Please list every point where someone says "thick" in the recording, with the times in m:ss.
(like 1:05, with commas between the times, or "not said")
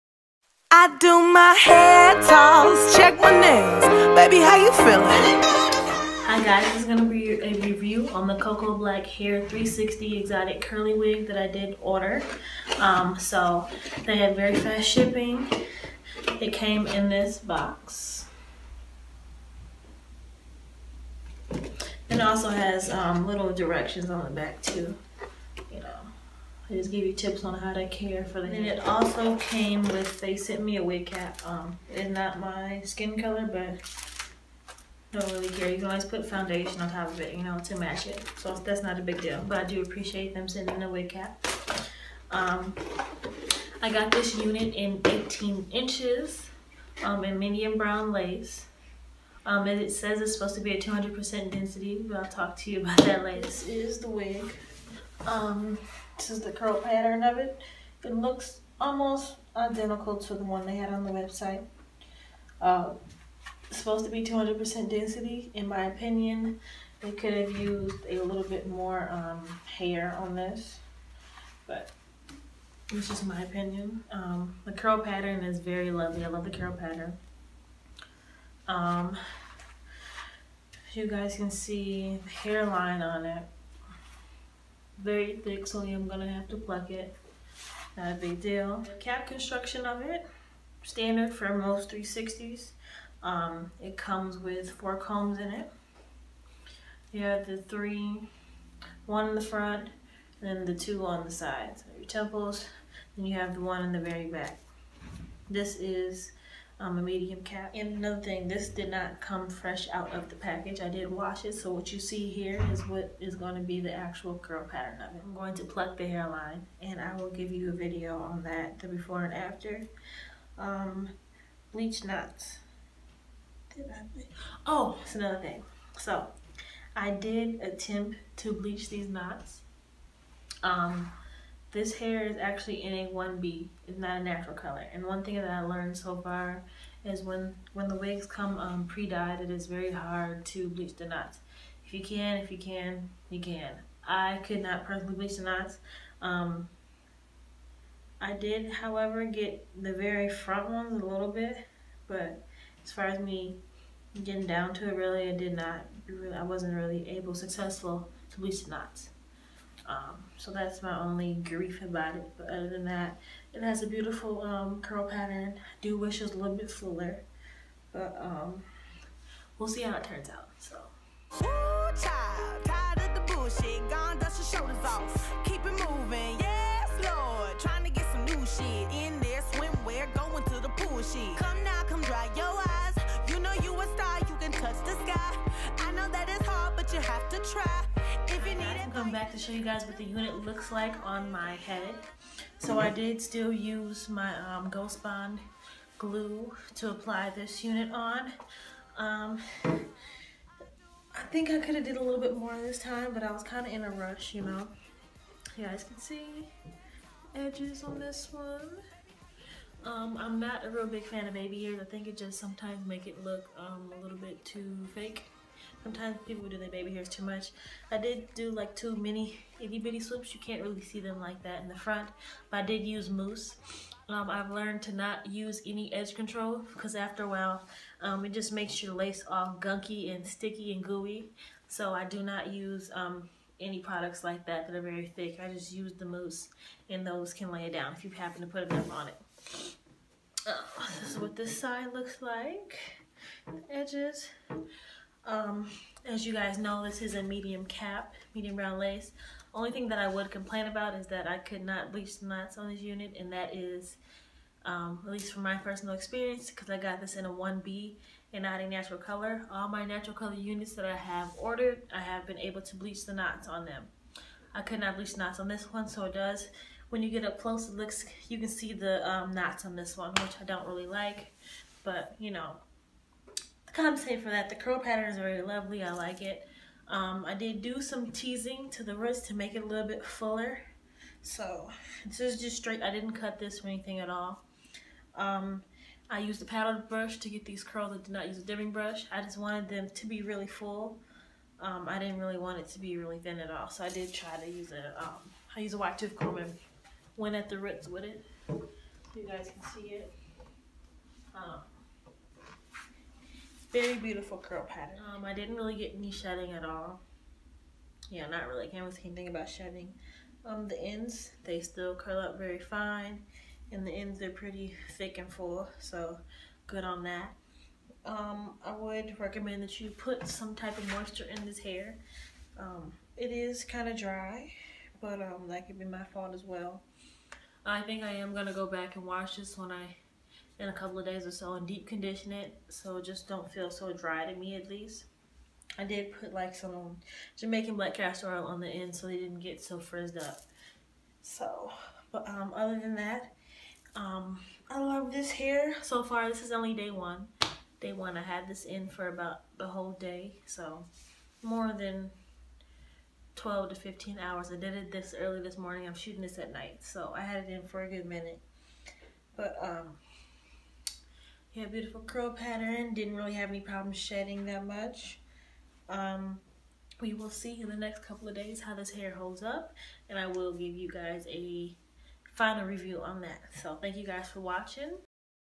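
1:25, 3:55, 5:14.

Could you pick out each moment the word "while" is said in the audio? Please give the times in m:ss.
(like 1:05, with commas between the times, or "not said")
3:47.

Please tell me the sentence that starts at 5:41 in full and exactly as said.
So, but um, other than that, um, I love this hair so far.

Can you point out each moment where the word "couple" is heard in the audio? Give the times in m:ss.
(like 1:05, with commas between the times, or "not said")
5:30, 6:08.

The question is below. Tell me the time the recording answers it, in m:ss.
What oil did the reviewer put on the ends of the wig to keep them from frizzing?
5:37.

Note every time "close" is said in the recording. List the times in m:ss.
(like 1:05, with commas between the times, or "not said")
4:27.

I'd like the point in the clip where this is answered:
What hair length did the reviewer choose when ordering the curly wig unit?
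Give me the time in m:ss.
0:45.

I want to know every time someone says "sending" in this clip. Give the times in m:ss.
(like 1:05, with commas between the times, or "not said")
0:40.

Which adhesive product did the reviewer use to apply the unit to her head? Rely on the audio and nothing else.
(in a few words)
Ghost Bond.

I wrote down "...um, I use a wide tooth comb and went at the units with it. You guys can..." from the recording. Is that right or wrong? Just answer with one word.
wrong.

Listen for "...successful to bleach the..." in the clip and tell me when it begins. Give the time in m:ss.
2:37.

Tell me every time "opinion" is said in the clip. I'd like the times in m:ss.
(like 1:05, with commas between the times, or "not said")
1:05, 1:13.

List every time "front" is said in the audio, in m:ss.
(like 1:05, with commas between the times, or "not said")
1:39, 2:30, 3:41.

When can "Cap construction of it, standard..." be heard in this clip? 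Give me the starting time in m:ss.
1:28.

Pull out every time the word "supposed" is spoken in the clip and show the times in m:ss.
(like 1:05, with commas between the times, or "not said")
0:50, 1:03.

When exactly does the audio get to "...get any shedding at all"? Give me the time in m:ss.
5:05.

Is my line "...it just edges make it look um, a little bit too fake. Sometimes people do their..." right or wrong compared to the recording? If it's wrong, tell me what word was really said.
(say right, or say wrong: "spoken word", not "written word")
wrong: "sometimes", not "edges".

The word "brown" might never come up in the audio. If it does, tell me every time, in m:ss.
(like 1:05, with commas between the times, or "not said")
0:47, 4:08.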